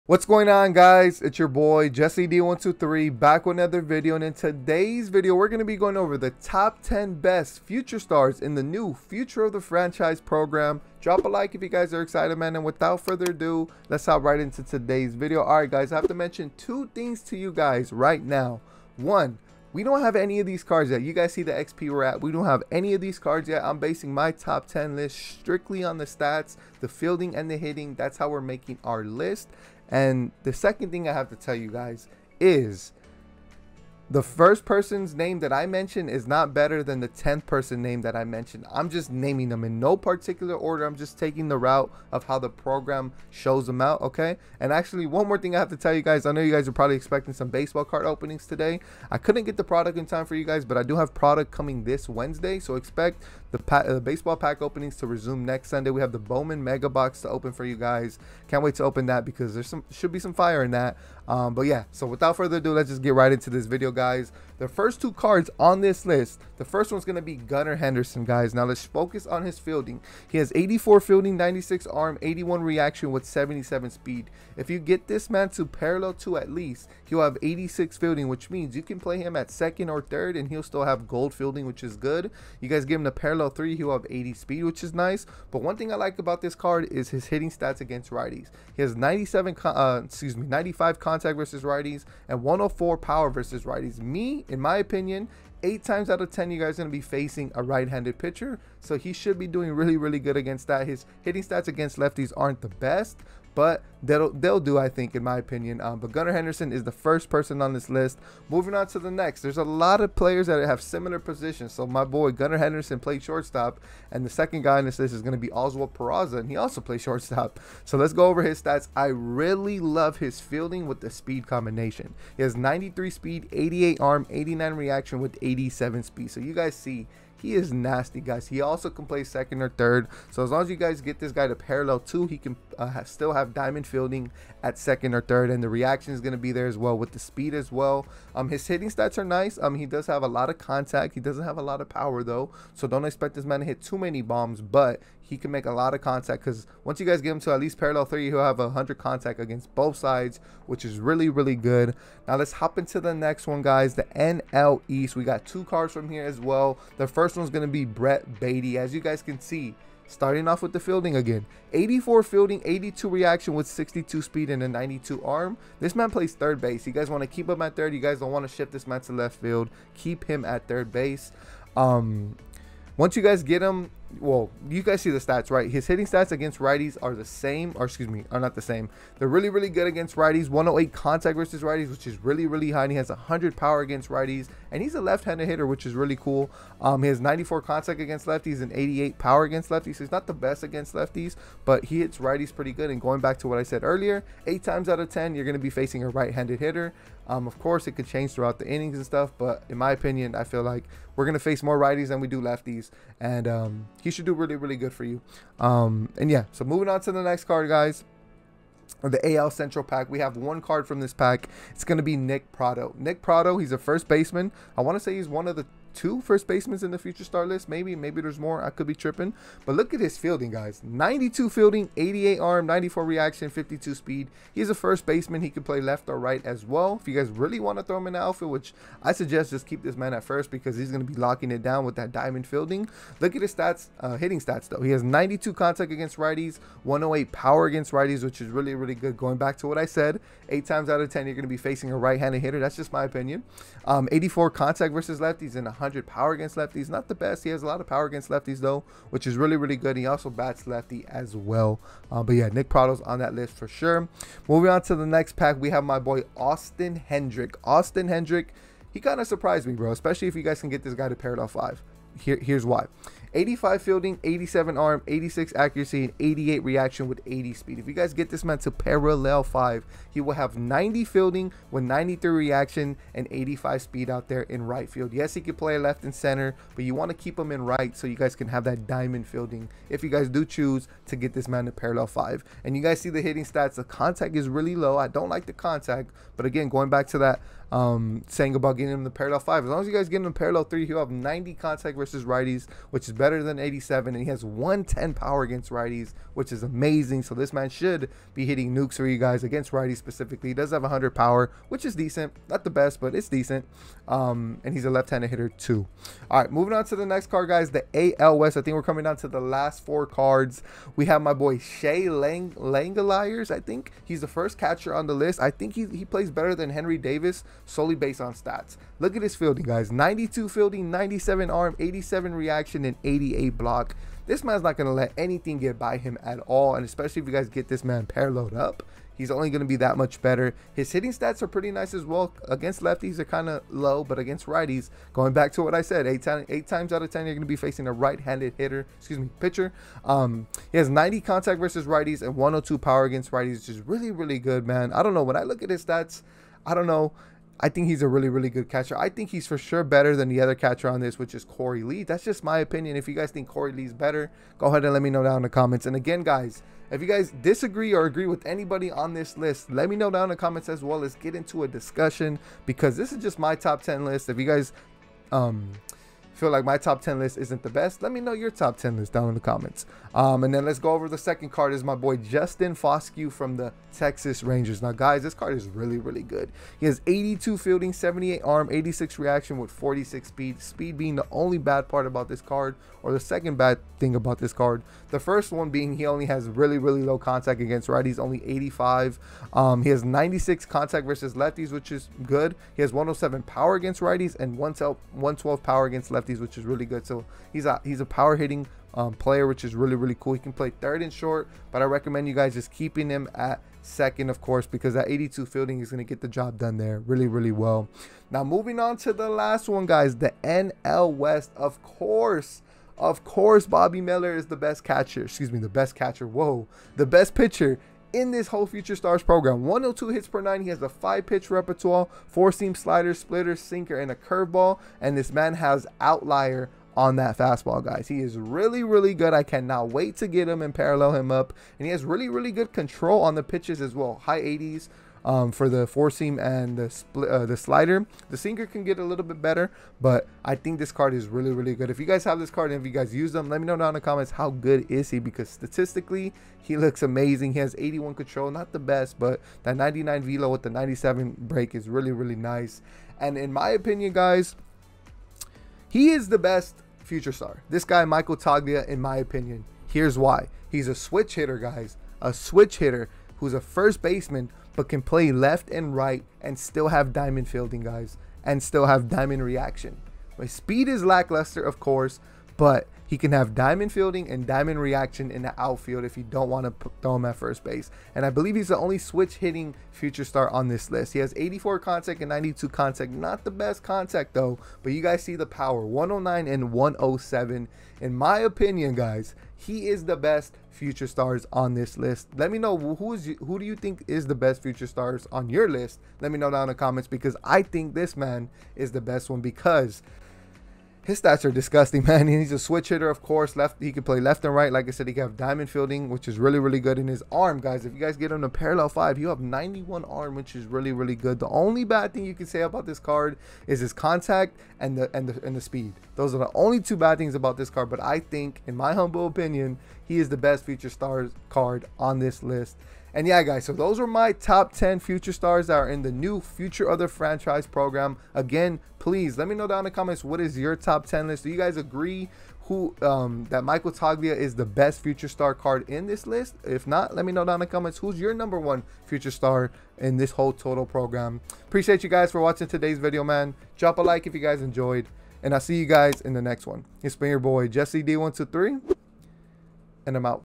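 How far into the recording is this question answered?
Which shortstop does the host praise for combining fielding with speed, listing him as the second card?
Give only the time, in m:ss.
1:55.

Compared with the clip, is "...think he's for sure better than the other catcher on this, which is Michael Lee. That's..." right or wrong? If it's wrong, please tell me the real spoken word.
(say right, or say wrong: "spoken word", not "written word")
wrong: "Korey", not "Michael".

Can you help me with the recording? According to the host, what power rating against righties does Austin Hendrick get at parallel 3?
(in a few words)
110.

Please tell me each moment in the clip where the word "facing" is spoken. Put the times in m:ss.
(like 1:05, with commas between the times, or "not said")
1:37, 3:15, 4:01, 5:37.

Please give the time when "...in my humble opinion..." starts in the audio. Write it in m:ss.
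8:38.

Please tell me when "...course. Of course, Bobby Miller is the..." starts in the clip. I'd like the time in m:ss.
6:51.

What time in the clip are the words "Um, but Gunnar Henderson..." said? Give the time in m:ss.
1:45.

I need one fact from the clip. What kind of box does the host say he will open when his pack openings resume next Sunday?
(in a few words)
Bowman Mega Box.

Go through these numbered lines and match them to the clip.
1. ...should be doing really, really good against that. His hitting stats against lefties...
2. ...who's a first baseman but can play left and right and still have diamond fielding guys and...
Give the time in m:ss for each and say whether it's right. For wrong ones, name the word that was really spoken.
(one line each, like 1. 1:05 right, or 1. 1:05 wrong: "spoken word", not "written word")
1. 1:39 right
2. 7:43 right.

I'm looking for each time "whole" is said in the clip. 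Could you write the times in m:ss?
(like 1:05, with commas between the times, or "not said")
6:58, 9:00.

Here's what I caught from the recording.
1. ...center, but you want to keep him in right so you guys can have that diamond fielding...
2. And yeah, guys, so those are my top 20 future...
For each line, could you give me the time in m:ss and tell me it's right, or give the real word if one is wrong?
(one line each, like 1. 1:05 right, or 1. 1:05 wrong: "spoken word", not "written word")
1. 4:36 right
2. 8:43 wrong: "10", not "20".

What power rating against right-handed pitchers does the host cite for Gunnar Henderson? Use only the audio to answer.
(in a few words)
104.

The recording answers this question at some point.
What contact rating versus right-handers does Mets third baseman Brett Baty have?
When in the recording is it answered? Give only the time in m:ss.
3:00.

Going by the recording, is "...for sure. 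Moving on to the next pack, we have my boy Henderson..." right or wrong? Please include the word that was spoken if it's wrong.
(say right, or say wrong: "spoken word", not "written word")
wrong: "Austin", not "Henderson".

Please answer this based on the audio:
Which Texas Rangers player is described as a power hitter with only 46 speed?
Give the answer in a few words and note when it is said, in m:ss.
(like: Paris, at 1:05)
Justin Foscue, at 6:12.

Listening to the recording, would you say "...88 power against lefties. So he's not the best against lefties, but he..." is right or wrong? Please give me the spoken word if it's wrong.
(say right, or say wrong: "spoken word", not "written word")
right.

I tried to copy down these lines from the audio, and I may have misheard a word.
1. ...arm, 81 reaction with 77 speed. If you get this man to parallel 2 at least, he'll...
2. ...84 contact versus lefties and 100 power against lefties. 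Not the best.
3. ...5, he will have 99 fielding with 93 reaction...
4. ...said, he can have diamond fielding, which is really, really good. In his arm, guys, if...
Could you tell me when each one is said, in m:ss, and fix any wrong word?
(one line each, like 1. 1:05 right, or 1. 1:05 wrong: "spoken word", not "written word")
1. 1:11 right
2. 4:04 right
3. 4:29 wrong: "90", not "99"
4. 8:24 right.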